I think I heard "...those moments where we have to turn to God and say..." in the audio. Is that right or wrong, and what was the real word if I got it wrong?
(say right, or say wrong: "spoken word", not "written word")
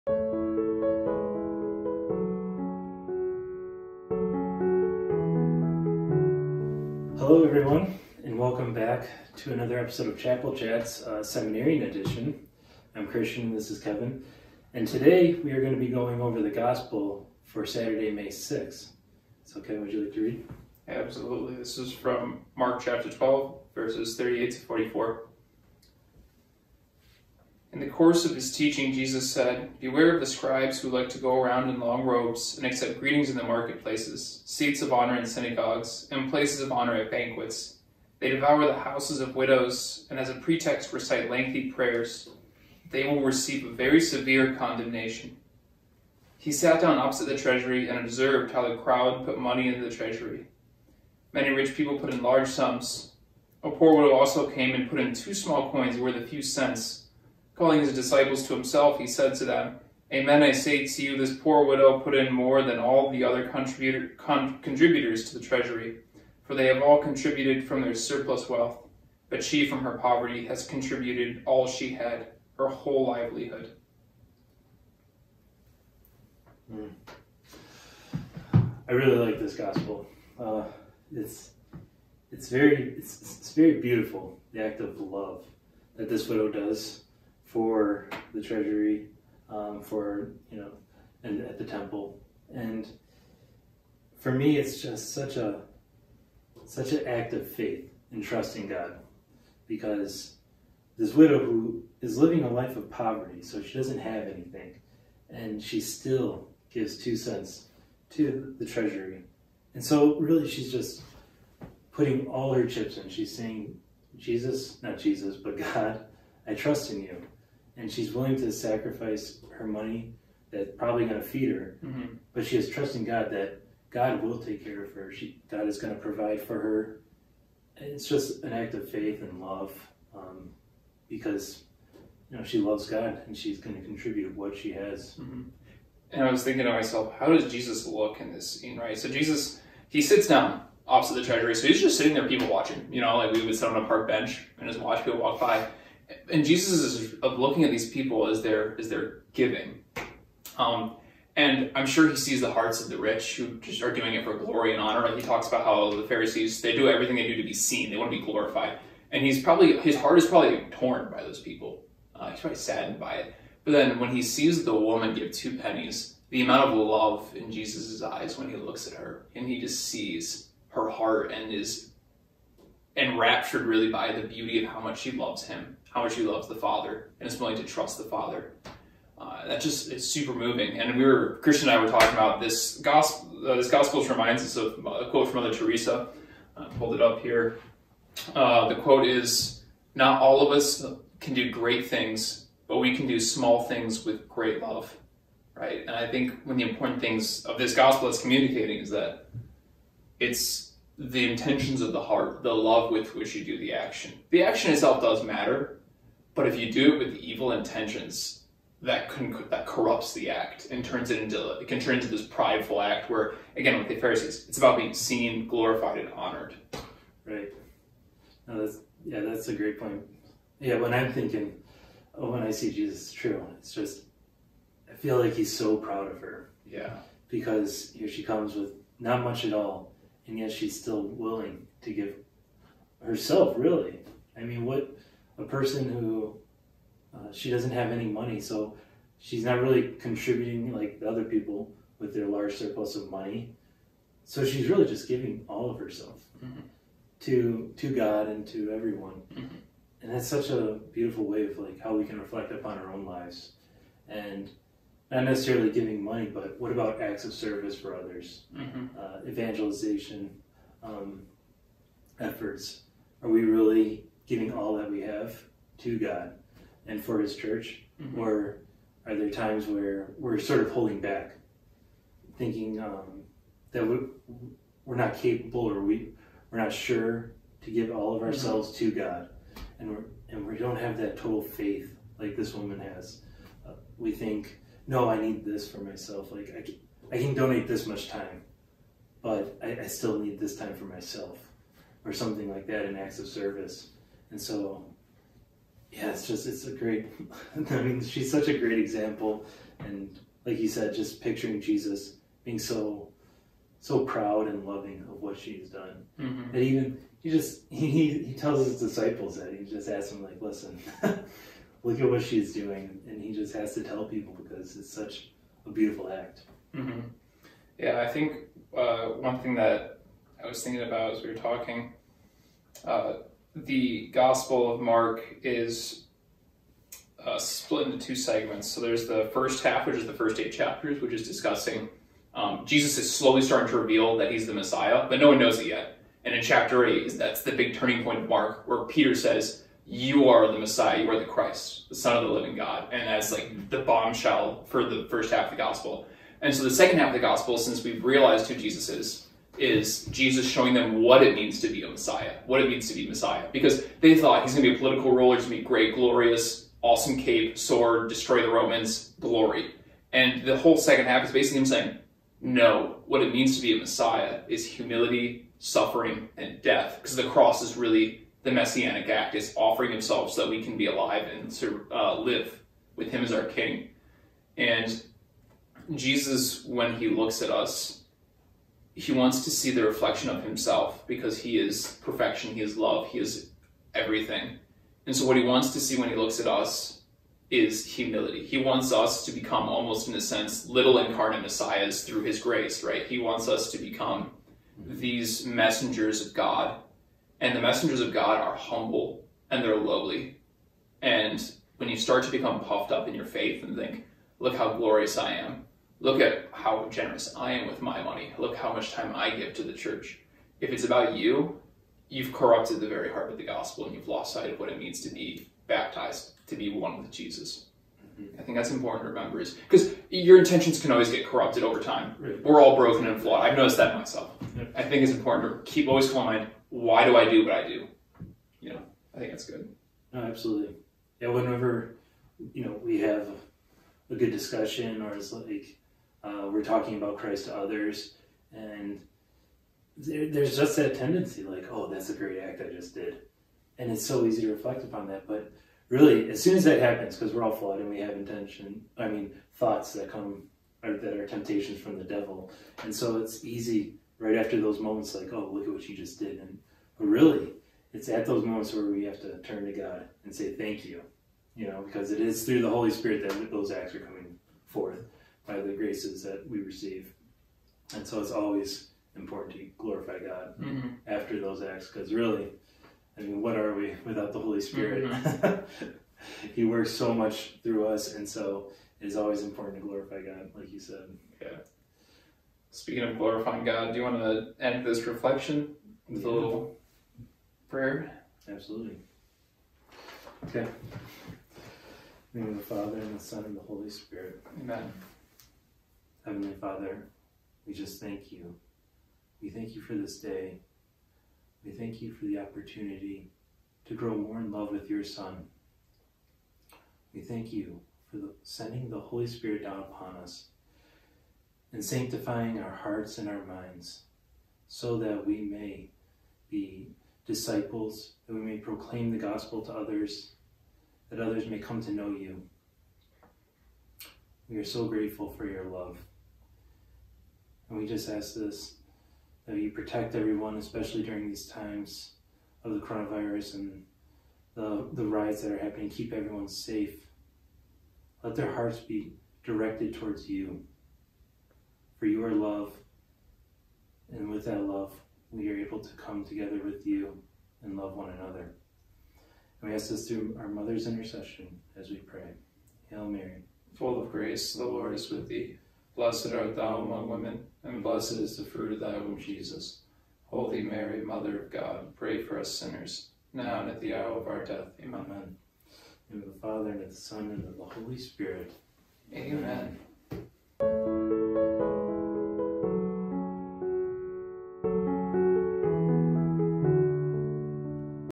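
right.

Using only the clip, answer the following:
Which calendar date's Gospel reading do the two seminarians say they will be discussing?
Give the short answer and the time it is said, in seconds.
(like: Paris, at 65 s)
Saturday, May 6th, at 17 s.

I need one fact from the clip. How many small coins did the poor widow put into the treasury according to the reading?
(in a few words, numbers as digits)
2.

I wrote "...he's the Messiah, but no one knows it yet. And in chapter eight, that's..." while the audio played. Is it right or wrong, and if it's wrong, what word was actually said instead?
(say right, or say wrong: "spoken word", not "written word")
right.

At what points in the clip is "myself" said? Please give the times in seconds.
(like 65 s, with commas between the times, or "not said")
136 s, 285 s, 290 s, 423 s.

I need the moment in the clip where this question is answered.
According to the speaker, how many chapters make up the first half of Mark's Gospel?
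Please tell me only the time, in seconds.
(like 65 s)
330 s.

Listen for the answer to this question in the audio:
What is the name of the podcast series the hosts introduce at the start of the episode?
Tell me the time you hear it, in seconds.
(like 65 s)
10 s.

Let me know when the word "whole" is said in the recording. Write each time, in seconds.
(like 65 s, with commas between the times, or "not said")
72 s, 360 s.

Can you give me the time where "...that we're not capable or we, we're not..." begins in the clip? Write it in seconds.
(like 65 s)
273 s.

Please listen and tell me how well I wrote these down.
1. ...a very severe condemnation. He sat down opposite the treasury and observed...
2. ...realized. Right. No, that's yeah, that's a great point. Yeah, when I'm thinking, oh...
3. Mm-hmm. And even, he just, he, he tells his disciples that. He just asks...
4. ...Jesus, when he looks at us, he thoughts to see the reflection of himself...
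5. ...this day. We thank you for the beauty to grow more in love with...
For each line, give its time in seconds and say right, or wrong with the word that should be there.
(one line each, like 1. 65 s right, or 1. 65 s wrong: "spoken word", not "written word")
1. 43 s right
2. 216 s wrong: "honored", not "realized"
3. 306 s right
4. 375 s wrong: "wants", not "thoughts"
5. 499 s wrong: "opportunity", not "beauty".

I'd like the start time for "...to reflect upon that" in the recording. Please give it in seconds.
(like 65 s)
444 s.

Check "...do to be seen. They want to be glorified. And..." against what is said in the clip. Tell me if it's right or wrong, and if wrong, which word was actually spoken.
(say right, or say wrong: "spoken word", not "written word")
right.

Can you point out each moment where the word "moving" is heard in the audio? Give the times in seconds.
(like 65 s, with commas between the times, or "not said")
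180 s.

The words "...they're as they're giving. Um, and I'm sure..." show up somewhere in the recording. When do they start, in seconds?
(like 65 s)
148 s.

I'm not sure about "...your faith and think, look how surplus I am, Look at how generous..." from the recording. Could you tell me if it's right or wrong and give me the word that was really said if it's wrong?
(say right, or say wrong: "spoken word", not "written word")
wrong: "glorious", not "surplus".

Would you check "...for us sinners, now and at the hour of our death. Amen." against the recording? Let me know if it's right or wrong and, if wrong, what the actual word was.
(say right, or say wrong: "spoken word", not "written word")
right.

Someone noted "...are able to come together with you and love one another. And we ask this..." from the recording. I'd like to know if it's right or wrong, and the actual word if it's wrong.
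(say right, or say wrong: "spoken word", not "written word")
right.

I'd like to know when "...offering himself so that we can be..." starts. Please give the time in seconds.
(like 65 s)
369 s.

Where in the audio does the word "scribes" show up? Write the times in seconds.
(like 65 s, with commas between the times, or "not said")
30 s.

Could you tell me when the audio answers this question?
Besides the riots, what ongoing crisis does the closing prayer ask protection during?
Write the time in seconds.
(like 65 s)
532 s.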